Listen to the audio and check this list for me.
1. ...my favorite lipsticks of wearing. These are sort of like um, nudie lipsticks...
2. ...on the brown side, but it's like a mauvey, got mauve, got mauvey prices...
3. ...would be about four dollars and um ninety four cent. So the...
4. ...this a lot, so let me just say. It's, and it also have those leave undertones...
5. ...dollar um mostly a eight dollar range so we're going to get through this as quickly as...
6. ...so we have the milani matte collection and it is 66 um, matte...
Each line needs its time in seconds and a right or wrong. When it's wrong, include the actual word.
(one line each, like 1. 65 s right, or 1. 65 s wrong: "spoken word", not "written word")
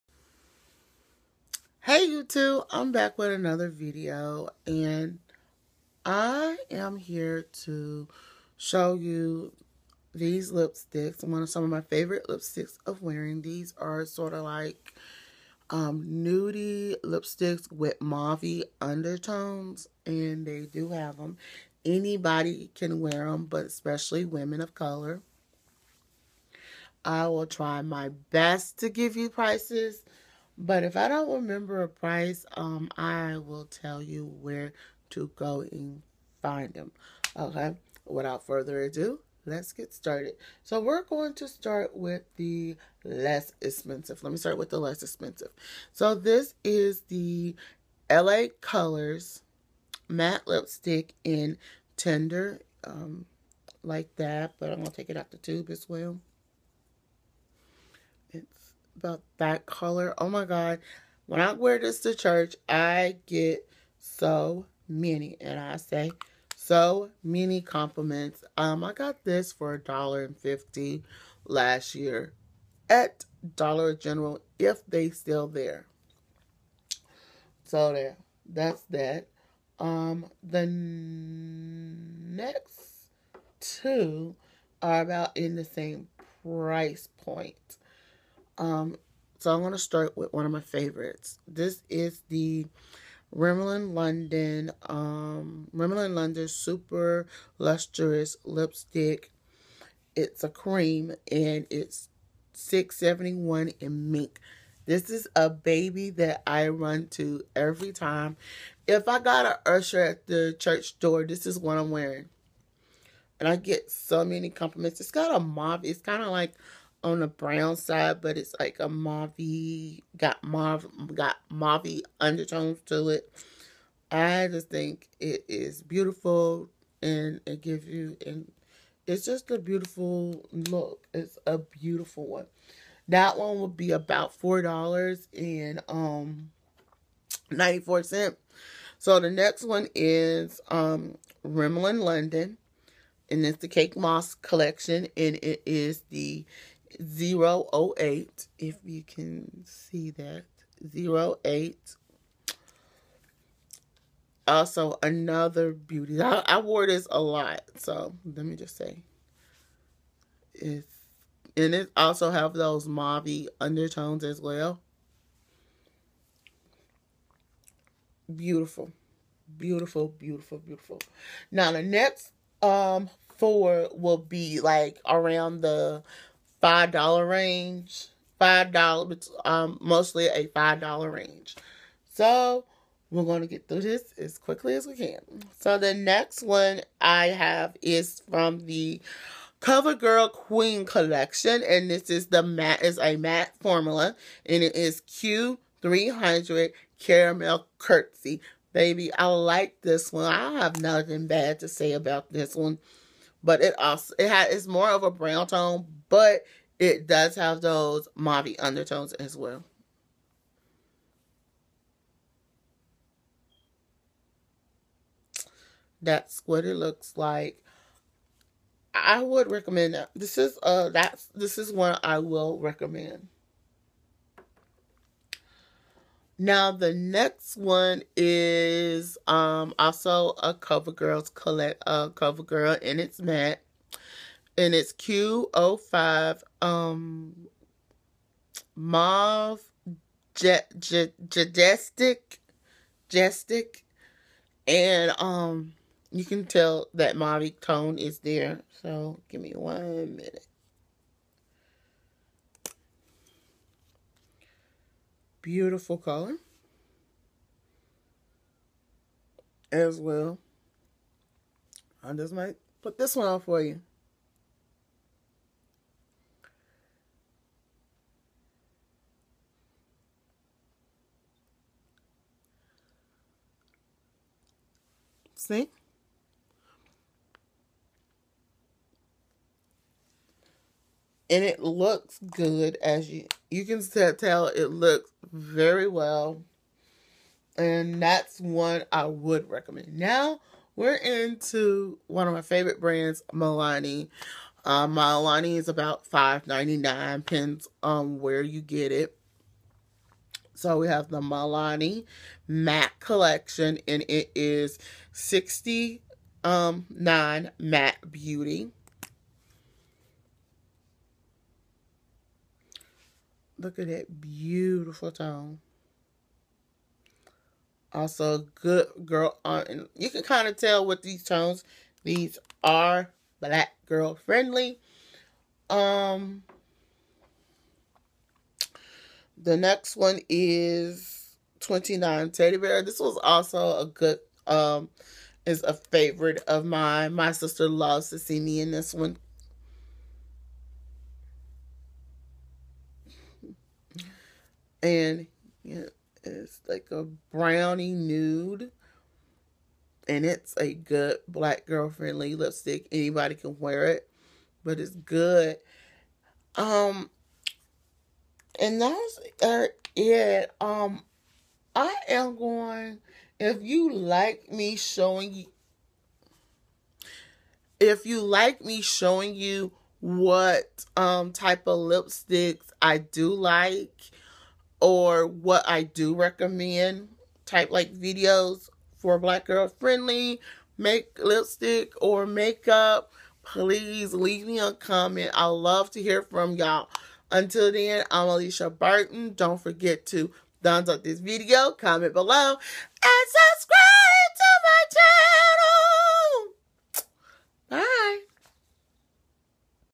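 1. 11 s right
2. 117 s wrong: "undertones", not "prices"
3. 133 s right
4. 156 s wrong: "mauve", not "leave"
5. 178 s wrong: "five", not "eight"
6. 300 s wrong: "69", not "66".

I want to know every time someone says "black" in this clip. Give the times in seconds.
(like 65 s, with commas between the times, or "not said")
323 s, 351 s, 379 s.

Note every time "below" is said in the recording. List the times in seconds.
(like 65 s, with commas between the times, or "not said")
392 s.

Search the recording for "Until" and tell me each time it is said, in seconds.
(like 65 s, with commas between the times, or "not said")
387 s.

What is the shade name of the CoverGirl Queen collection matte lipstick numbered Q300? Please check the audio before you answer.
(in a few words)
Caramel Curtsy.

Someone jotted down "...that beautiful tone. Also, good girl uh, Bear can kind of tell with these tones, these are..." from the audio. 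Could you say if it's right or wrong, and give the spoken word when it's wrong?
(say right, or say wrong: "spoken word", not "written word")
wrong: "You", not "Bear".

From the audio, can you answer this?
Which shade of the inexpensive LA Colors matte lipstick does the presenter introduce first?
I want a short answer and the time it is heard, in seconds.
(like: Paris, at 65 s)
Tender, at 51 s.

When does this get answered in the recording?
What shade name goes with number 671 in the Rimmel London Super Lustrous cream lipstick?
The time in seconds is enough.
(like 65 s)
104 s.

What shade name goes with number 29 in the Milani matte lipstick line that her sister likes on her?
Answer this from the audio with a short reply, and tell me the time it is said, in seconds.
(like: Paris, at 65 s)
Teddy Bear, at 332 s.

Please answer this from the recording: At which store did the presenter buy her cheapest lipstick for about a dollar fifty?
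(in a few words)
Dollar General.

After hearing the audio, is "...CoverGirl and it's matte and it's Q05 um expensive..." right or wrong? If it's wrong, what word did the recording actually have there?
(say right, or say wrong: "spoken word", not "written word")
wrong: "mauve", not "expensive".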